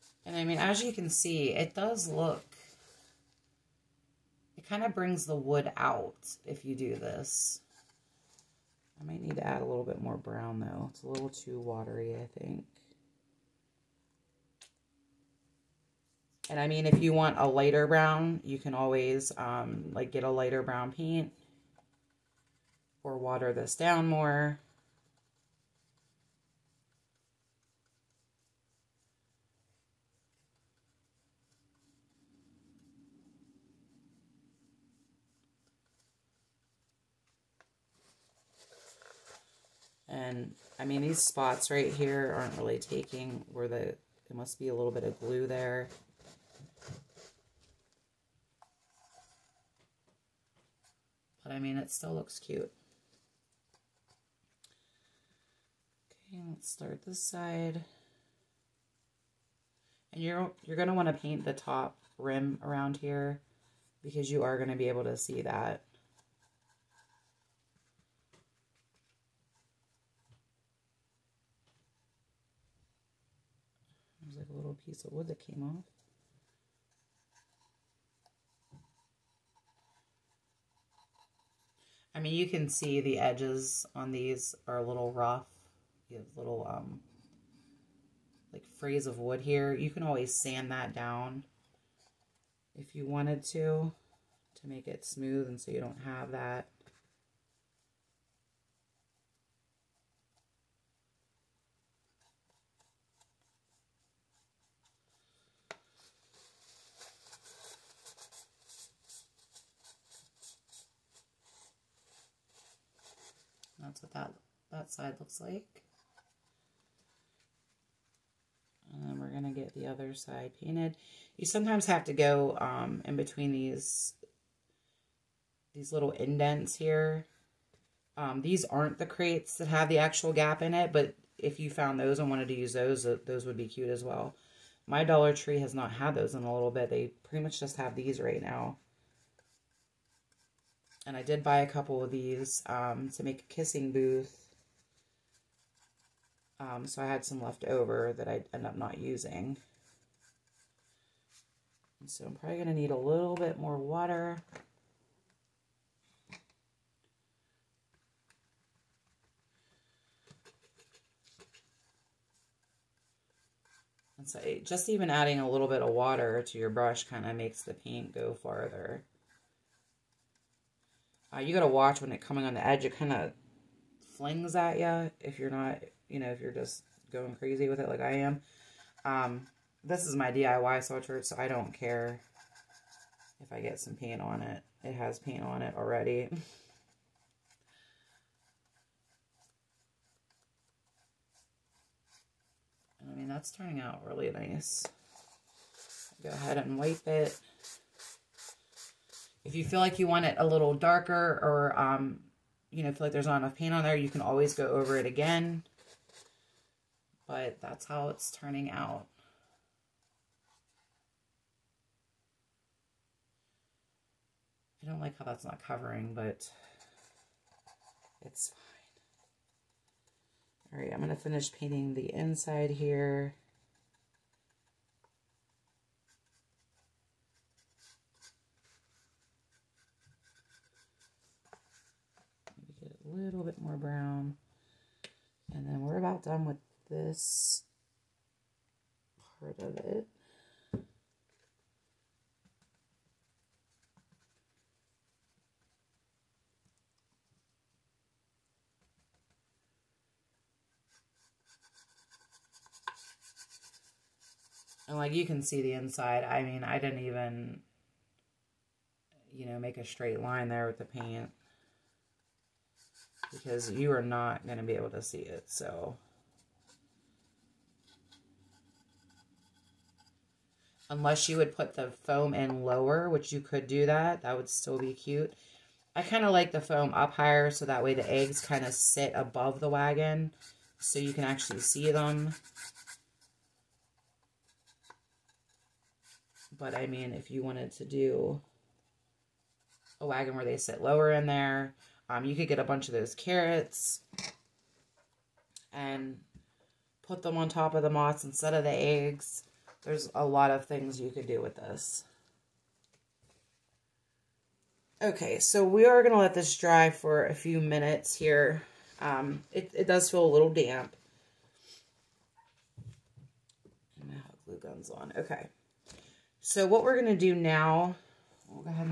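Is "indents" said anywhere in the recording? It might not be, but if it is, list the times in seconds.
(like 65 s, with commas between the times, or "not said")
126 s.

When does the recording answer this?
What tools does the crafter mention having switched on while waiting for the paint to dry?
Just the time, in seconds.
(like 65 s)
314 s.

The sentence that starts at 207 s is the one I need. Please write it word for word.
But that's how it's turning out.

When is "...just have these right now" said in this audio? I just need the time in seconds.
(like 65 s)
137 s.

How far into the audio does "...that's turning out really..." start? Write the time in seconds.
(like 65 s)
193 s.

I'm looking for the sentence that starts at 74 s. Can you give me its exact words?
little piece of wood that came off.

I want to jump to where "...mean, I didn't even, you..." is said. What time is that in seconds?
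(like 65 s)
256 s.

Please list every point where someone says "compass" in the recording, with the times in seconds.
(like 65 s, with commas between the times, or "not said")
not said.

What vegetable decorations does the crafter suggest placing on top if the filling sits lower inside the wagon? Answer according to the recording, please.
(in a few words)
carrots.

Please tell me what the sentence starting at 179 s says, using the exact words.
Um, this is my DIY sweatshirt, so I don't care if I get some paint on it.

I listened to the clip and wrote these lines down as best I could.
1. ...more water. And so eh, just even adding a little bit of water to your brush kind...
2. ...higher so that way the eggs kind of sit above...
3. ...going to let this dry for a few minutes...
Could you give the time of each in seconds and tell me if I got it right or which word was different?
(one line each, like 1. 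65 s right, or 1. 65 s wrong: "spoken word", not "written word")
1. 153 s right
2. 277 s right
3. 306 s right.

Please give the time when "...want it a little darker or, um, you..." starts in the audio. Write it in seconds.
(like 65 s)
200 s.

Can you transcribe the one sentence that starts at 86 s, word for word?
You have little, um, like, frays of wood here.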